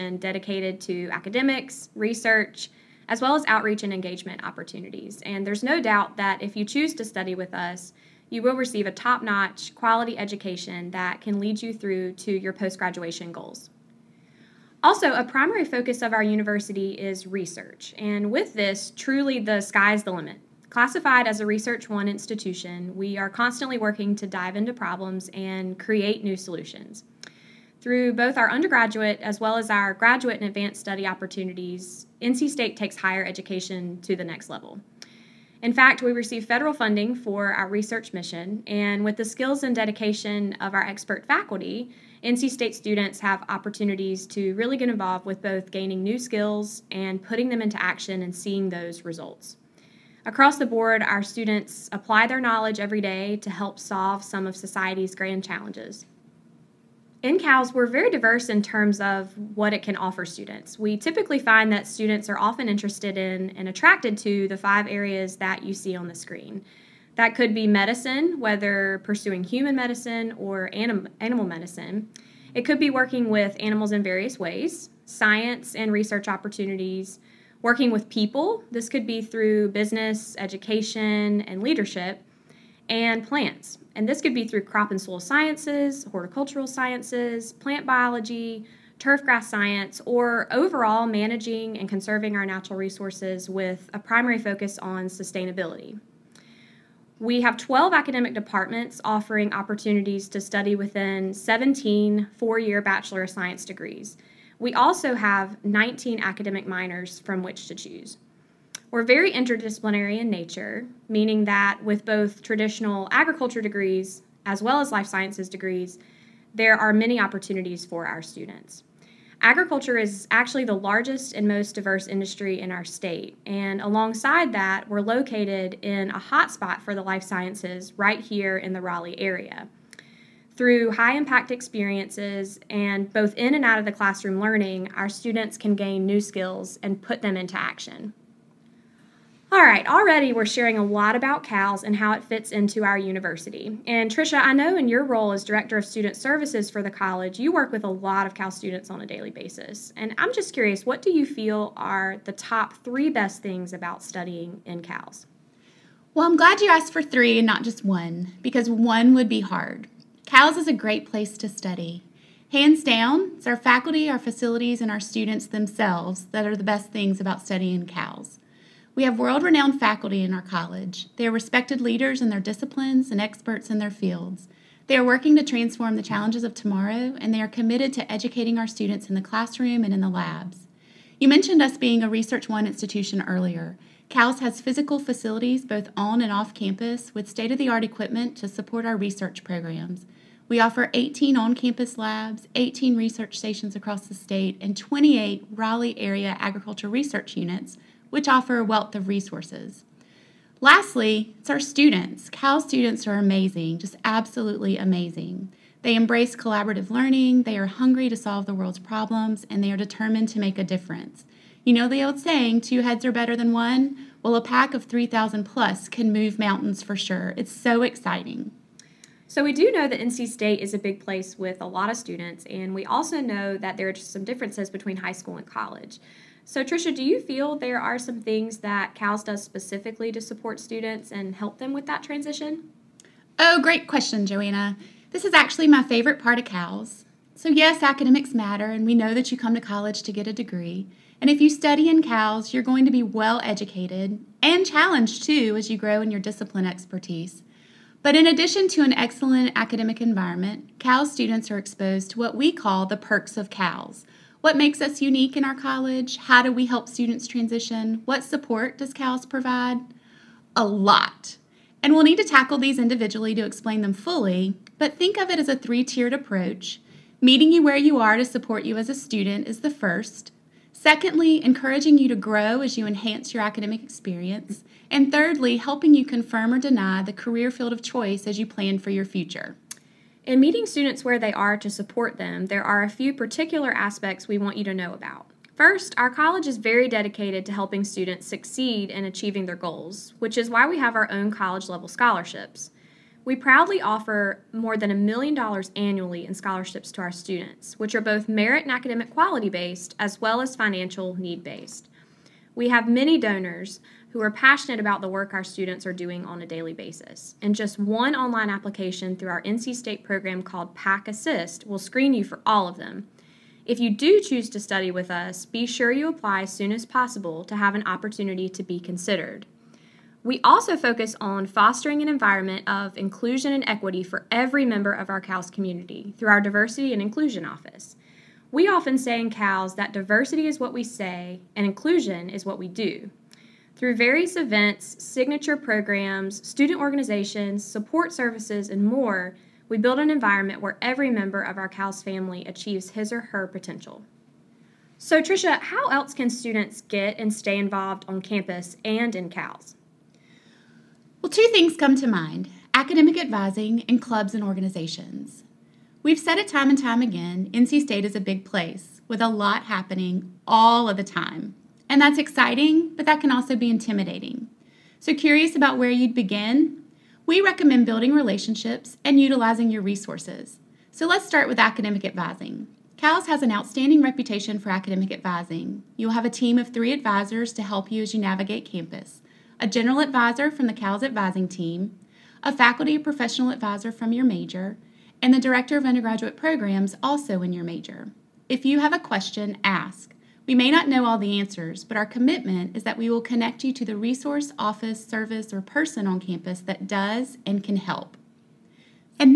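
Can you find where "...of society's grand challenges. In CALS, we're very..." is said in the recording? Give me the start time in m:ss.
0:54.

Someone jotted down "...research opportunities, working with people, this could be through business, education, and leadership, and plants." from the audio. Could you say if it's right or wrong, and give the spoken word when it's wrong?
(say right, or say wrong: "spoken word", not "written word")
right.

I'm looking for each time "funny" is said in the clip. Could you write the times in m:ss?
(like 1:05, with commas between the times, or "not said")
not said.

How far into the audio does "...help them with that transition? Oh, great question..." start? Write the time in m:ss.
3:51.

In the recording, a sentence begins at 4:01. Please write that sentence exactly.
And if you study in CALS, you're going to be well educated and challenged too as you grow in your discipline expertise.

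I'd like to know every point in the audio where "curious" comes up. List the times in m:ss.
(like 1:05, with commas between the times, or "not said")
2:30, 6:05.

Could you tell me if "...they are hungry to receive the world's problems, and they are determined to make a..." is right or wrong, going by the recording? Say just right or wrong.
wrong.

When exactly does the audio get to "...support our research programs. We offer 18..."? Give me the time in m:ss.
3:08.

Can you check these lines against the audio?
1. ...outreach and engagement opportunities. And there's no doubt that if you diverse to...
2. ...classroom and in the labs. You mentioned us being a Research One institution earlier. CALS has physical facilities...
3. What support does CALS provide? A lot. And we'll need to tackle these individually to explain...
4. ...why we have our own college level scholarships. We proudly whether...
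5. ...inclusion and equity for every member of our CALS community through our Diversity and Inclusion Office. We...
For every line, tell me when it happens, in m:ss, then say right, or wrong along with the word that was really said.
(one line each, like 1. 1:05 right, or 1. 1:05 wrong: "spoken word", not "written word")
1. 0:03 wrong: "choose", not "diverse"
2. 2:59 right
3. 4:18 right
4. 4:50 wrong: "offer", not "whether"
5. 5:22 right.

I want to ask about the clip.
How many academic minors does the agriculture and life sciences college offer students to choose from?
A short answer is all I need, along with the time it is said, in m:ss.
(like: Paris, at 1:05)
19, at 1:45.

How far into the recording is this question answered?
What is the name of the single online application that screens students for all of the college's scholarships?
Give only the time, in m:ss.
5:10.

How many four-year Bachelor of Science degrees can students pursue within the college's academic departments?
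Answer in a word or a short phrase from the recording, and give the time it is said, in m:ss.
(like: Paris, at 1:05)
17, at 1:41.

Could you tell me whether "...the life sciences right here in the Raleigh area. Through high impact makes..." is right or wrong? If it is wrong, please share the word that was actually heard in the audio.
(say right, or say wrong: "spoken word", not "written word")
wrong: "experiences", not "makes".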